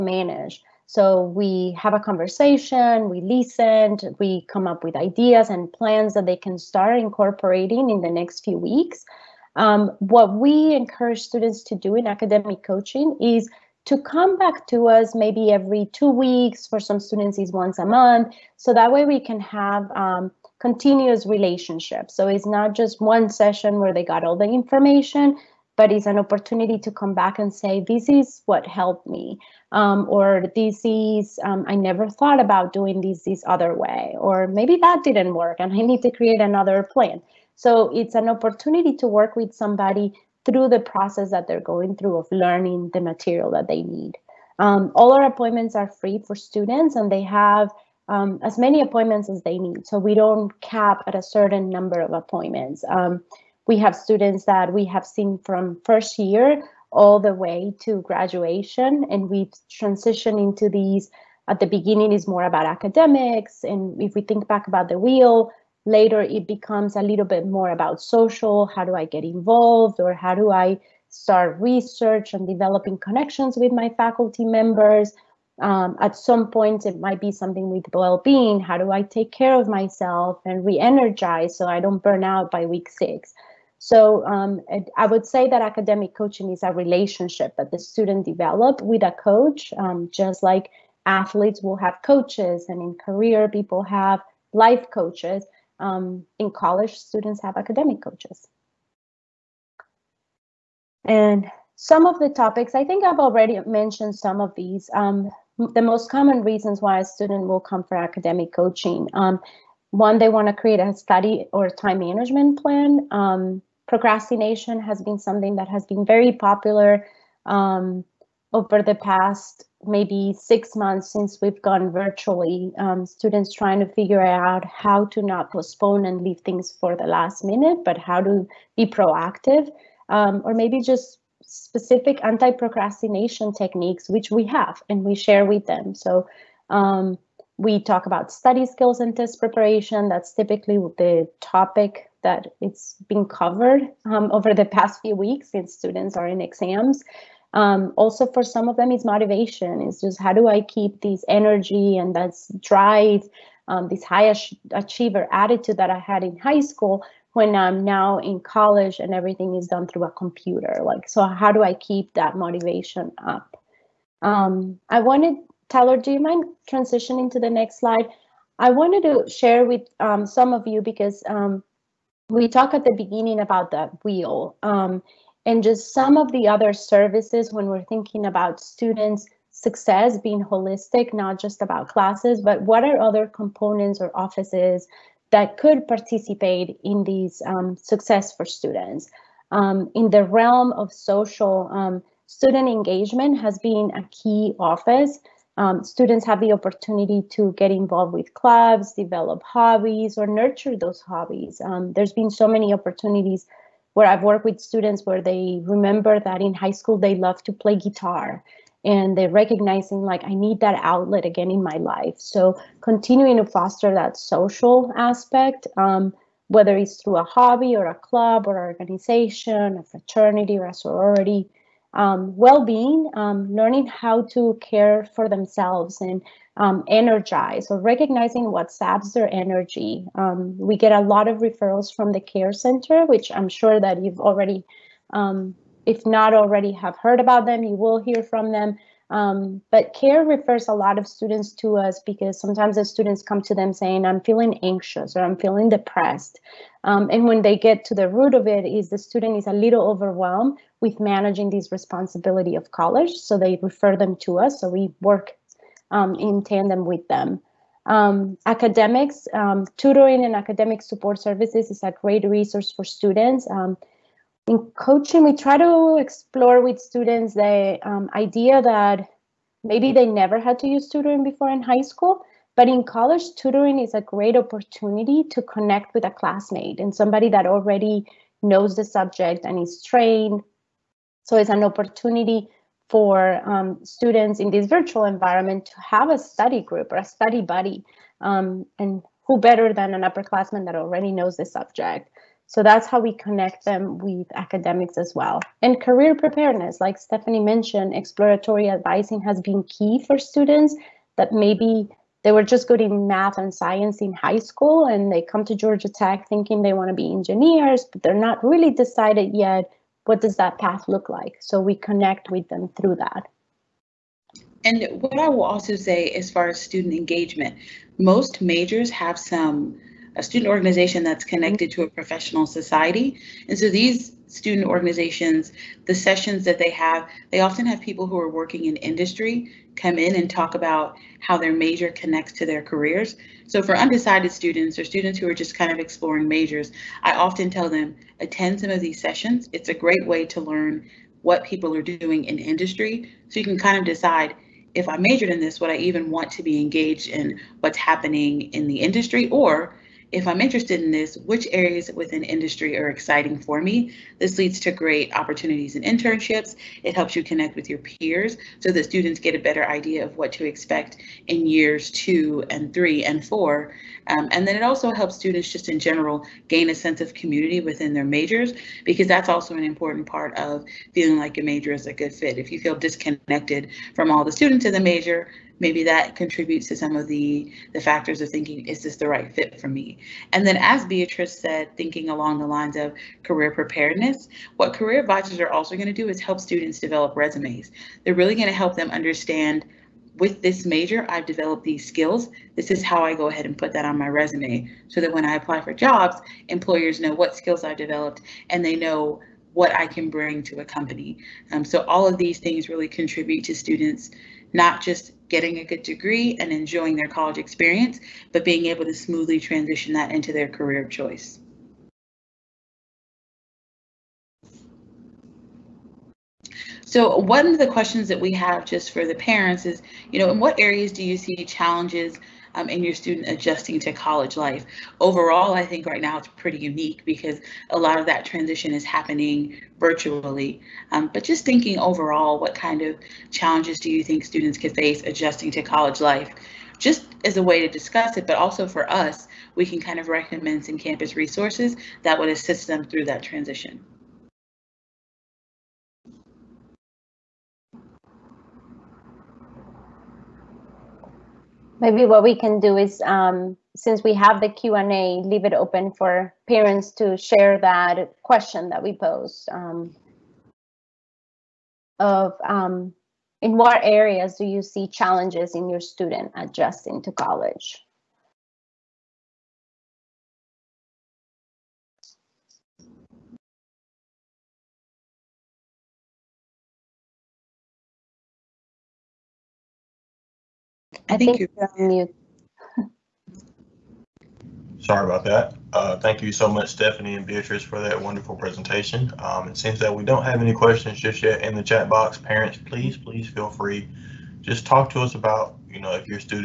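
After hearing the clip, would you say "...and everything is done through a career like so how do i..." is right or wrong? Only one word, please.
wrong.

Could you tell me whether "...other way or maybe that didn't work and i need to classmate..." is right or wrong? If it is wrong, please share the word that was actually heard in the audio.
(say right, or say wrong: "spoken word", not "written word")
wrong: "create", not "classmate".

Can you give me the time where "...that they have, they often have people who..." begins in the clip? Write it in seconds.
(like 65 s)
326 s.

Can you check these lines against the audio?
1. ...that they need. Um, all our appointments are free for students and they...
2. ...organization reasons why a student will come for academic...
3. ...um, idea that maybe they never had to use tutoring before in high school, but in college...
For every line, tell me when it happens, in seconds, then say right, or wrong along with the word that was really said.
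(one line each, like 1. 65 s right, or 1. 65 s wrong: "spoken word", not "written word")
1. 43 s right
2. 106 s wrong: "common", not "organization"
3. 267 s right.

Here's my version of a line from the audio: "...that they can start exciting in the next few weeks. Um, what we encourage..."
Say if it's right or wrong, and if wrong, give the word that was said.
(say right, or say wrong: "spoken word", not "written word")
wrong: "incorporating", not "exciting".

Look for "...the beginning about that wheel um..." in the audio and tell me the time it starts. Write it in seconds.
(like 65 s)
172 s.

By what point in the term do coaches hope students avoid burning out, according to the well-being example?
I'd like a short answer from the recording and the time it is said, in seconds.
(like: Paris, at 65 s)
week six, at 82 s.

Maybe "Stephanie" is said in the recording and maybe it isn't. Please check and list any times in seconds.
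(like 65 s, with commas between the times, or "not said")
296 s, 486 s.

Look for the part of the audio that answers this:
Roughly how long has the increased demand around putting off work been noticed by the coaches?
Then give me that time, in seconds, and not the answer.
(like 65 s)
120 s.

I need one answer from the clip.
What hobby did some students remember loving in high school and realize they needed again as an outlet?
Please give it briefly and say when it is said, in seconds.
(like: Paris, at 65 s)
play guitar, at 207 s.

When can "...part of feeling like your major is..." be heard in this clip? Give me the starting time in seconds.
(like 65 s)
370 s.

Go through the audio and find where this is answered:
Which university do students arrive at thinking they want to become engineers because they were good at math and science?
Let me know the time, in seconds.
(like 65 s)
305 s.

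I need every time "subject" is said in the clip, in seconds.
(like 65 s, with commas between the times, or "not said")
278 s, 291 s.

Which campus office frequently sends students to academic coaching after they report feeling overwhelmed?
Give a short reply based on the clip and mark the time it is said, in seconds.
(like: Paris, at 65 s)
care center, at 232 s.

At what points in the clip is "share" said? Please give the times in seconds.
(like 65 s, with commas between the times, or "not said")
135 s, 169 s, 457 s.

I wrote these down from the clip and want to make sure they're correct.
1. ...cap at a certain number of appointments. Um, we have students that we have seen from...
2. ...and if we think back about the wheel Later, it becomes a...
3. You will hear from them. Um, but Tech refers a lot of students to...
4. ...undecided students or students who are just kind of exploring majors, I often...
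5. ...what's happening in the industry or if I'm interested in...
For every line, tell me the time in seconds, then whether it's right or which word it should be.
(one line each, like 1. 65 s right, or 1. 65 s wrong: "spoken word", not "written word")
1. 50 s right
2. 63 s right
3. 237 s wrong: "CARE", not "Tech"
4. 333 s right
5. 347 s right.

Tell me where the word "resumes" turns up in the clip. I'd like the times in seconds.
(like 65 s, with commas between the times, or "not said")
387 s, 394 s.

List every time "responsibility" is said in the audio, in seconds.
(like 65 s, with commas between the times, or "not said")
251 s.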